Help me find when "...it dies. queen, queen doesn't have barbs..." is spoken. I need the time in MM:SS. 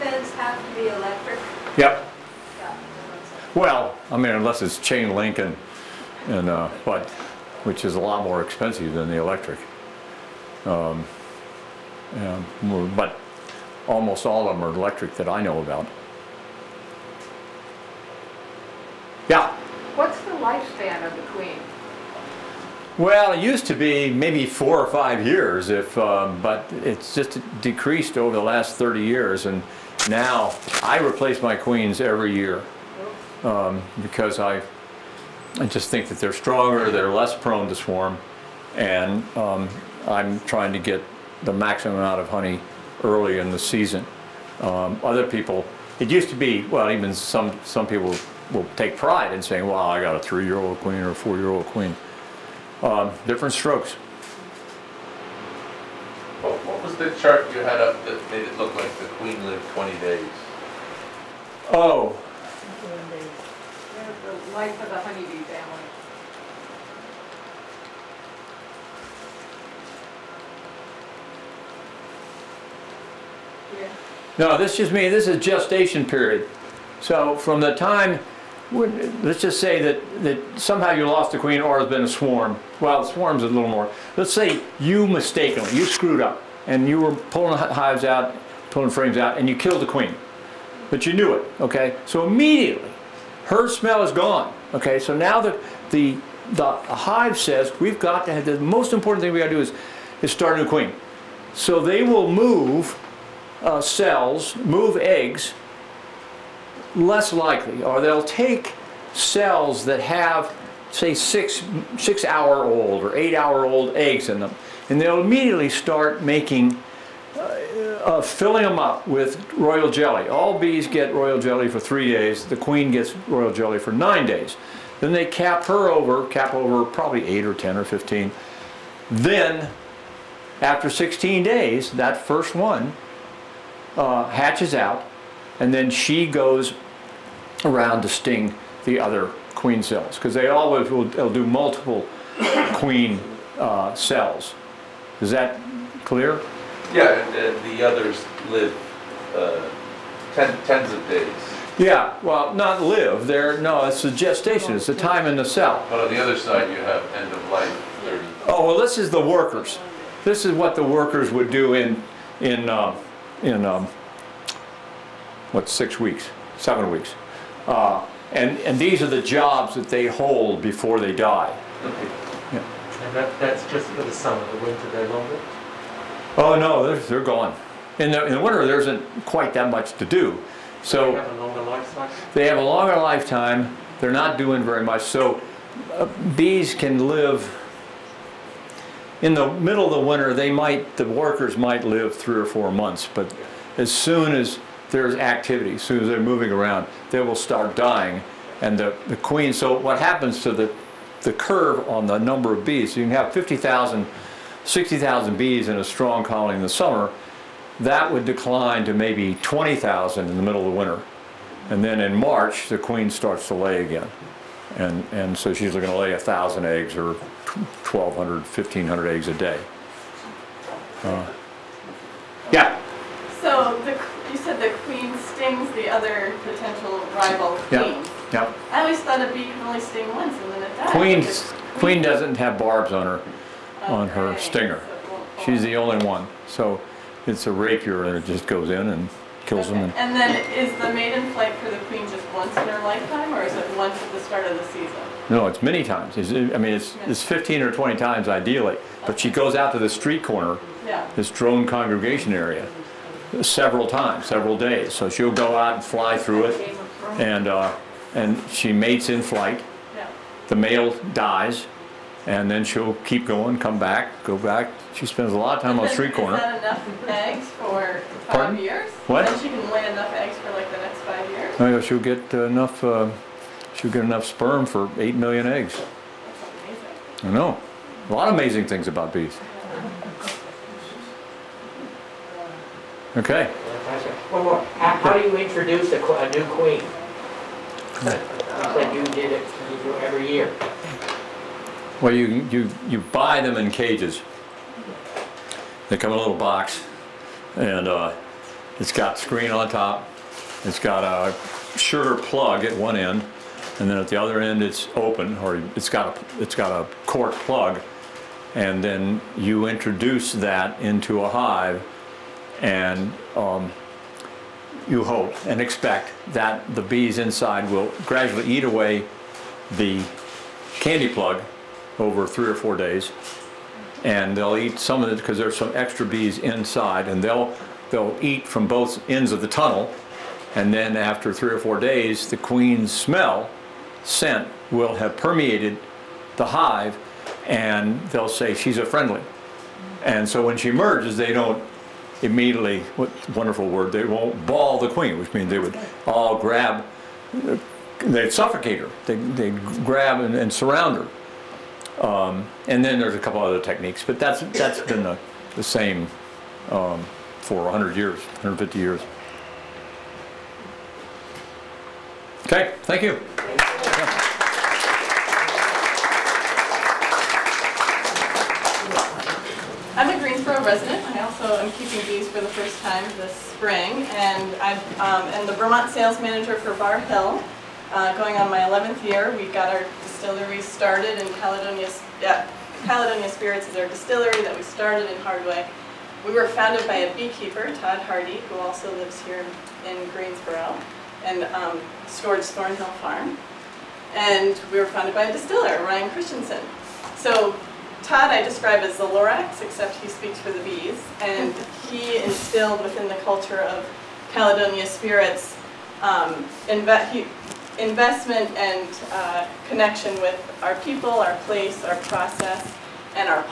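03:50.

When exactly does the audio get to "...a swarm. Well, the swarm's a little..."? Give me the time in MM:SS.
01:22.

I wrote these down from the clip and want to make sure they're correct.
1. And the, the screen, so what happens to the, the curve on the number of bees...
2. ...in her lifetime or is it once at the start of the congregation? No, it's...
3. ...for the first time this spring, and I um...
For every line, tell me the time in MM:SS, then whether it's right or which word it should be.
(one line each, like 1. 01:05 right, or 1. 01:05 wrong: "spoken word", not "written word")
1. 03:18 wrong: "queen", not "screen"
2. 04:02 wrong: "season", not "congregation"
3. 06:12 right.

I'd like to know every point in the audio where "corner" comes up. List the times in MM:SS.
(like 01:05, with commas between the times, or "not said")
04:10, 04:26.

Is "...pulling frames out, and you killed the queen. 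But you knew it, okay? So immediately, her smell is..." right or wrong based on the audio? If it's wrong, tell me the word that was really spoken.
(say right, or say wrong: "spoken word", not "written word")
right.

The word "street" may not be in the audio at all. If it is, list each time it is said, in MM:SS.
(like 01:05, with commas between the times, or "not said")
04:09, 04:25.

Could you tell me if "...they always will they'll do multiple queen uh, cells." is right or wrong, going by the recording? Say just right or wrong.
right.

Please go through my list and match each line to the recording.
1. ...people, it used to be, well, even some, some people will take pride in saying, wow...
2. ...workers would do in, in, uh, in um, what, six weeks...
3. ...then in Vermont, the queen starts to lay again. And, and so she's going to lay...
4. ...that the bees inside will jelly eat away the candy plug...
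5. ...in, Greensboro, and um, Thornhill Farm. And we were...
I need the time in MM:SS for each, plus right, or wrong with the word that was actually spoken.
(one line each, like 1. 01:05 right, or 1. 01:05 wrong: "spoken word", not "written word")
1. 00:45 right
2. 02:40 right
3. 03:31 wrong: "March", not "Vermont"
4. 05:16 wrong: "gradually", not "jelly"
5. 06:29 right.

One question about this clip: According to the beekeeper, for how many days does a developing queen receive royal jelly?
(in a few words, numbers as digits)
9 days.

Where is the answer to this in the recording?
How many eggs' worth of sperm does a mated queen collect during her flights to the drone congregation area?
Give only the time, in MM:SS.
04:34.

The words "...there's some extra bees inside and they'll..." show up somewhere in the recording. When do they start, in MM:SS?
05:25.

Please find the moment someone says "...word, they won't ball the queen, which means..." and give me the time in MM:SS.
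05:43.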